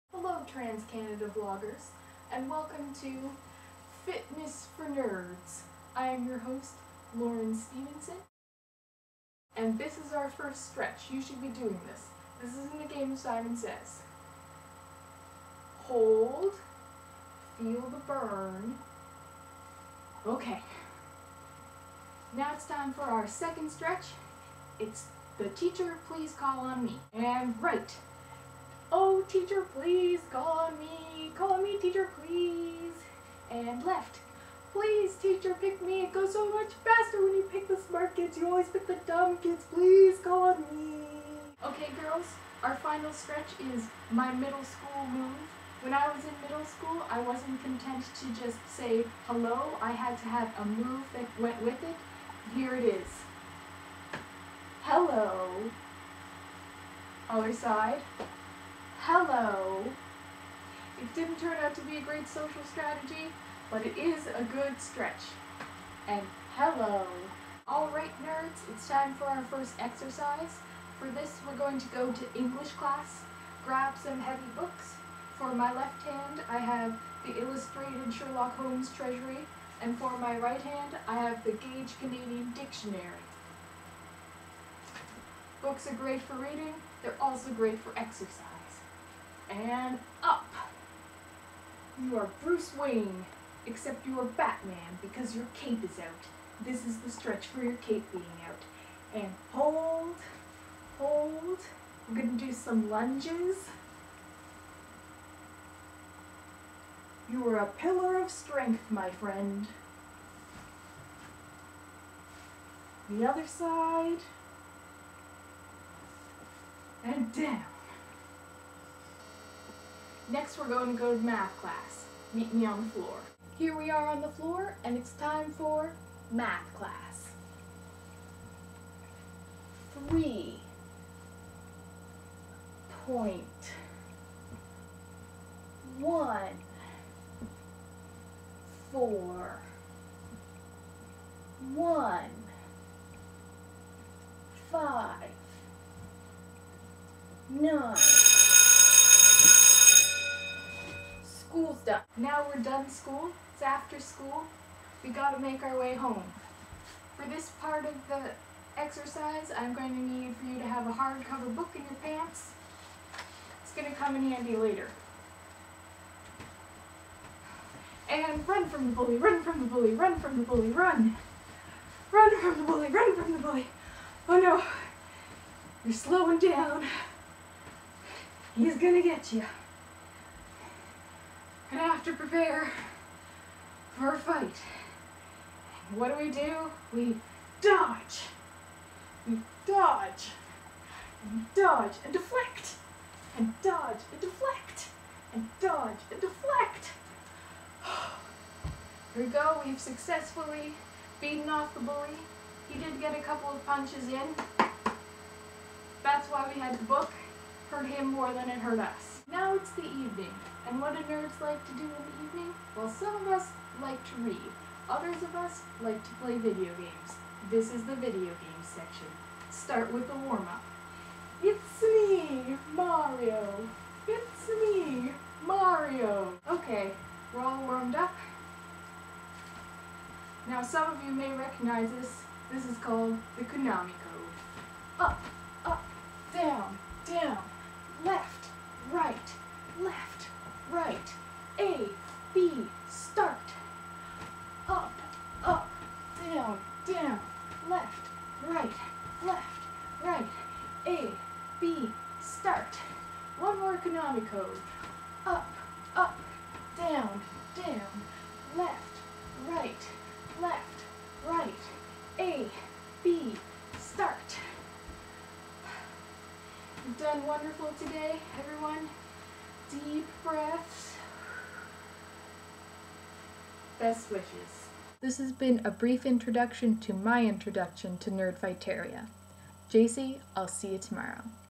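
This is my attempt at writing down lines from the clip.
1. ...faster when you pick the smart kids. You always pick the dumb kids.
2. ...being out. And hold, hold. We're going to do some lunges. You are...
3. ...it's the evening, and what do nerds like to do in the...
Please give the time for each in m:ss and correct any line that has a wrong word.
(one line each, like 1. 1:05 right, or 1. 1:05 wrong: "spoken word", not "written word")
1. 0:36 right
2. 1:38 right
3. 3:29 right.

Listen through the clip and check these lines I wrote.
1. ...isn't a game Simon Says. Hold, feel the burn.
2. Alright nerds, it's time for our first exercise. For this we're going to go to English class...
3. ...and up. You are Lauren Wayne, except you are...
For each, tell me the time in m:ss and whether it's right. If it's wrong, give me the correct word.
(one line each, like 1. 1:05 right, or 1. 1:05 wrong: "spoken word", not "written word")
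1. 0:12 right
2. 1:07 right
3. 1:29 wrong: "Bruce", not "Lauren".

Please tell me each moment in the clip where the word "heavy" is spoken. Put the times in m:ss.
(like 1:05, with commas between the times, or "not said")
1:14.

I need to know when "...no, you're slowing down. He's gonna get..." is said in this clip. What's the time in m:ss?
2:54.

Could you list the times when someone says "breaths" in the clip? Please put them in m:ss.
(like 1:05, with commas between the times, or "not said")
4:30.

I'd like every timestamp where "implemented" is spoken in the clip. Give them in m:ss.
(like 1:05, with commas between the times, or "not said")
not said.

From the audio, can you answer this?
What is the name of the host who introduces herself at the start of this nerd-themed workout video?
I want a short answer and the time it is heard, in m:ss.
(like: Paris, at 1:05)
Lauren Stevenson, at 0:07.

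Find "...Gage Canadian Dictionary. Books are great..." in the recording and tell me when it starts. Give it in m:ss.
1:21.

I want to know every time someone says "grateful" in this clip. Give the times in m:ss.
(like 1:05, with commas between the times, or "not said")
not said.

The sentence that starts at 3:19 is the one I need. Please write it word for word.
We've successfully beaten off the bully.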